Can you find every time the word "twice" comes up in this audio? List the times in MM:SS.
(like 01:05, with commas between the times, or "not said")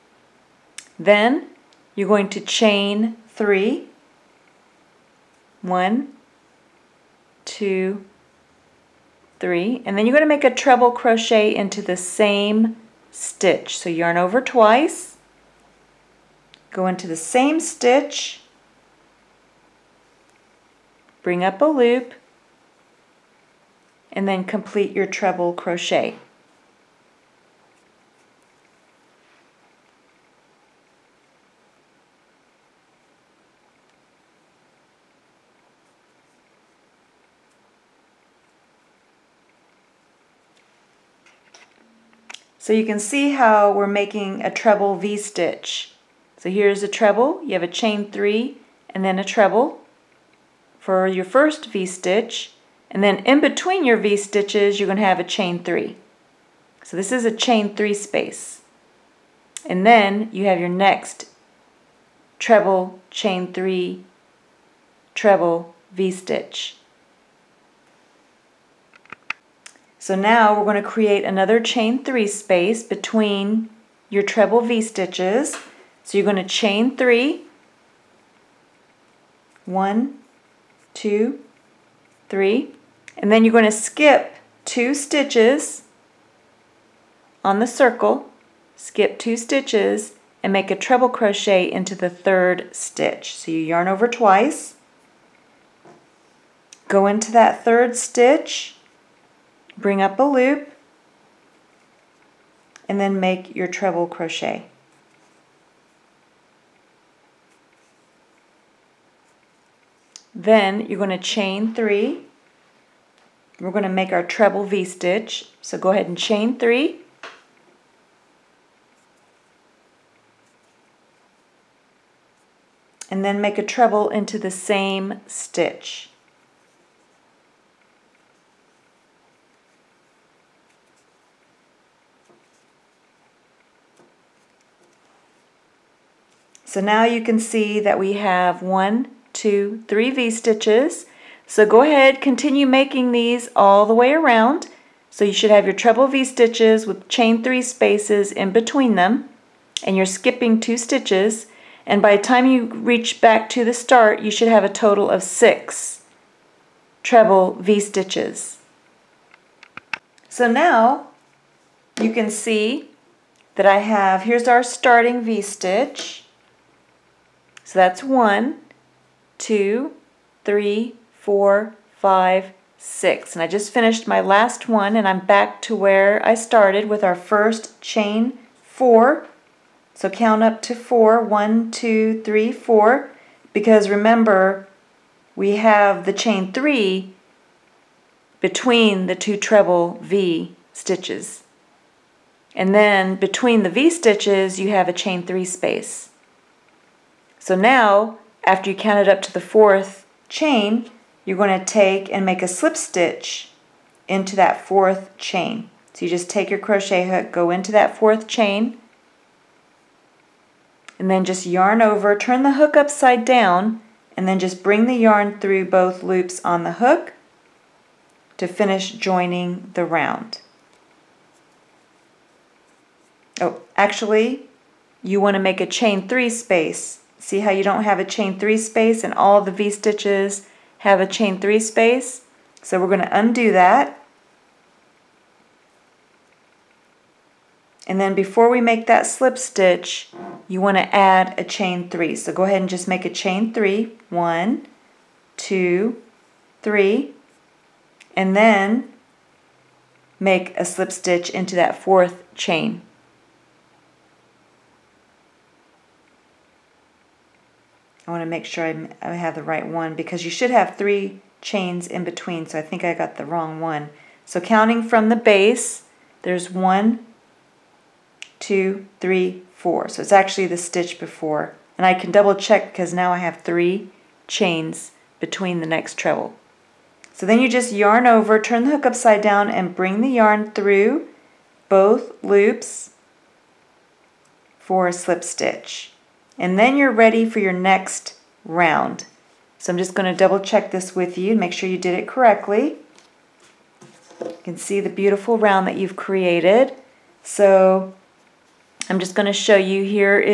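00:14, 01:34.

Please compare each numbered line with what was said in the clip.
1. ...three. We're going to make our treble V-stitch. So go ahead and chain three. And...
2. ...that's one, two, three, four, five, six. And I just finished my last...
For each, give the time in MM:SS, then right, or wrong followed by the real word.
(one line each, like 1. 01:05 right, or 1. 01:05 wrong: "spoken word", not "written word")
1. 01:51 right
2. 02:47 right.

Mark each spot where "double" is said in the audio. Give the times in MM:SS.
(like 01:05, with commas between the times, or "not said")
04:32, 04:50.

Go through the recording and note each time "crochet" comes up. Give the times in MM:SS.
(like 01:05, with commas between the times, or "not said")
00:10, 00:25, 01:31, 01:44, 03:26.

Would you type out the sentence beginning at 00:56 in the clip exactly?
So this is a chain three space.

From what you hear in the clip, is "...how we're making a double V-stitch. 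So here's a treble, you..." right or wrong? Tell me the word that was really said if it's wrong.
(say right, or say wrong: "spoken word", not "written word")
wrong: "treble", not "double".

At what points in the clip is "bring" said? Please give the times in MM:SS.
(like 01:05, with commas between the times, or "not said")
00:21, 01:39, 03:34, 04:39.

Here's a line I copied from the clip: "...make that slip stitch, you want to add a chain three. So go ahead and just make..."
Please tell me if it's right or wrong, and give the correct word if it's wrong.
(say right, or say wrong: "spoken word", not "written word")
right.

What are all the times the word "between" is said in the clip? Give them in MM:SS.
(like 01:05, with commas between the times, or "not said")
00:53, 01:12, 02:28, 03:08, 03:13, 04:22, 04:35.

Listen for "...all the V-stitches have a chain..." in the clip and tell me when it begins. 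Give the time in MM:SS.
03:49.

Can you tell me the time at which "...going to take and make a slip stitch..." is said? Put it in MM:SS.
03:21.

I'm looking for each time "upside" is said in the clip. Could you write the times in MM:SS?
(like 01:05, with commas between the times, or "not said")
03:32, 04:38.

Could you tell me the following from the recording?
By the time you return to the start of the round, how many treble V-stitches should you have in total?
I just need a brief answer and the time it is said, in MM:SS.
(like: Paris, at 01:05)
6, at 02:35.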